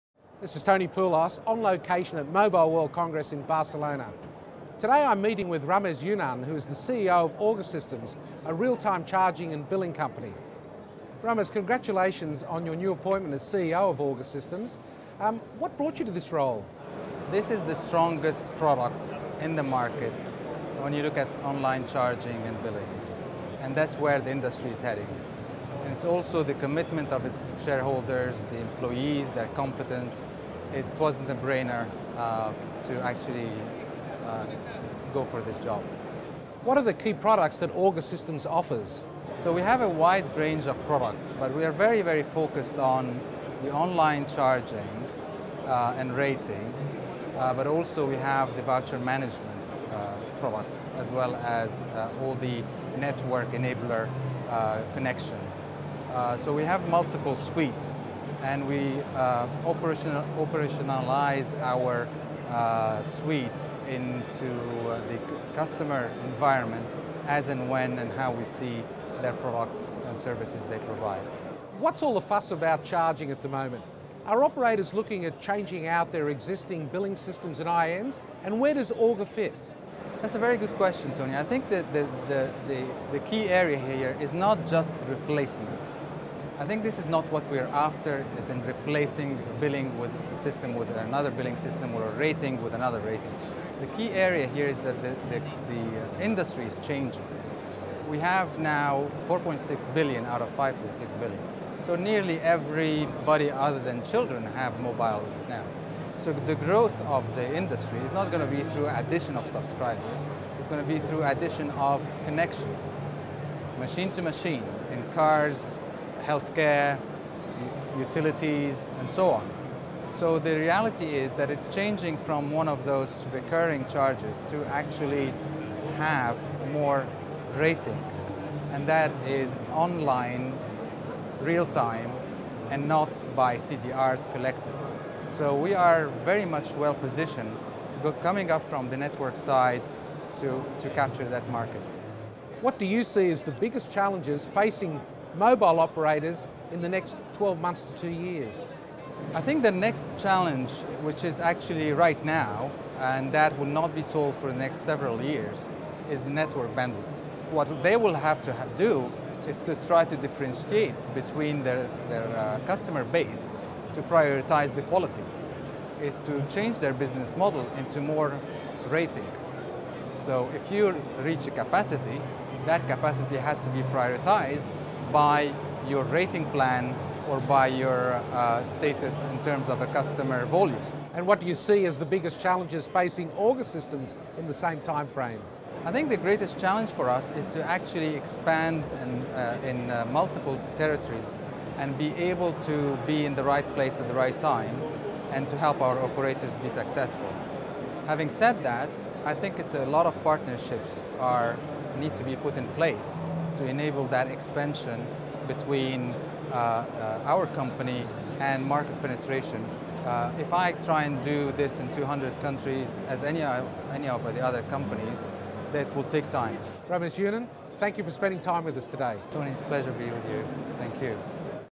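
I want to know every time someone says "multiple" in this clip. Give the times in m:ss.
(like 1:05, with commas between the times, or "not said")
0:56, 3:10.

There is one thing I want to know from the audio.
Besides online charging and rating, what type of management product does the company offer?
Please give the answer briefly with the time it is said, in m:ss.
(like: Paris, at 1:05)
voucher management, at 0:48.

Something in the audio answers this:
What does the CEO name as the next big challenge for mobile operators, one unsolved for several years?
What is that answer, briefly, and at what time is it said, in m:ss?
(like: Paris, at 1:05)
network bandwidth, at 2:36.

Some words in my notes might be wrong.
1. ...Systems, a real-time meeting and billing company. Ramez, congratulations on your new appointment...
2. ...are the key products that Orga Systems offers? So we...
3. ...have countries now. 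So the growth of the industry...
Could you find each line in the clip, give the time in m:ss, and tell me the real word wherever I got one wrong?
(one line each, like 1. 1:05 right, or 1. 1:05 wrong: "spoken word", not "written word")
1. 0:07 wrong: "charging", not "meeting"
2. 0:36 right
3. 1:44 wrong: "mobiles", not "countries".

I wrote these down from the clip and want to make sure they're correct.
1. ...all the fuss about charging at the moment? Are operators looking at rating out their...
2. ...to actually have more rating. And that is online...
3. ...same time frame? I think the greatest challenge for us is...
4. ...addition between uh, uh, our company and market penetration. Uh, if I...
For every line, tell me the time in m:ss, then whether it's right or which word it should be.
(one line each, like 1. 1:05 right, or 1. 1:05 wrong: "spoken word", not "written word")
1. 1:12 wrong: "changing", not "rating"
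2. 2:04 right
3. 3:04 right
4. 3:24 wrong: "expansion", not "addition".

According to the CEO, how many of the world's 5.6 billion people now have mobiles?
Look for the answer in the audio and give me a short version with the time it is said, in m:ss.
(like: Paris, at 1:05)
4.6 billion, at 1:39.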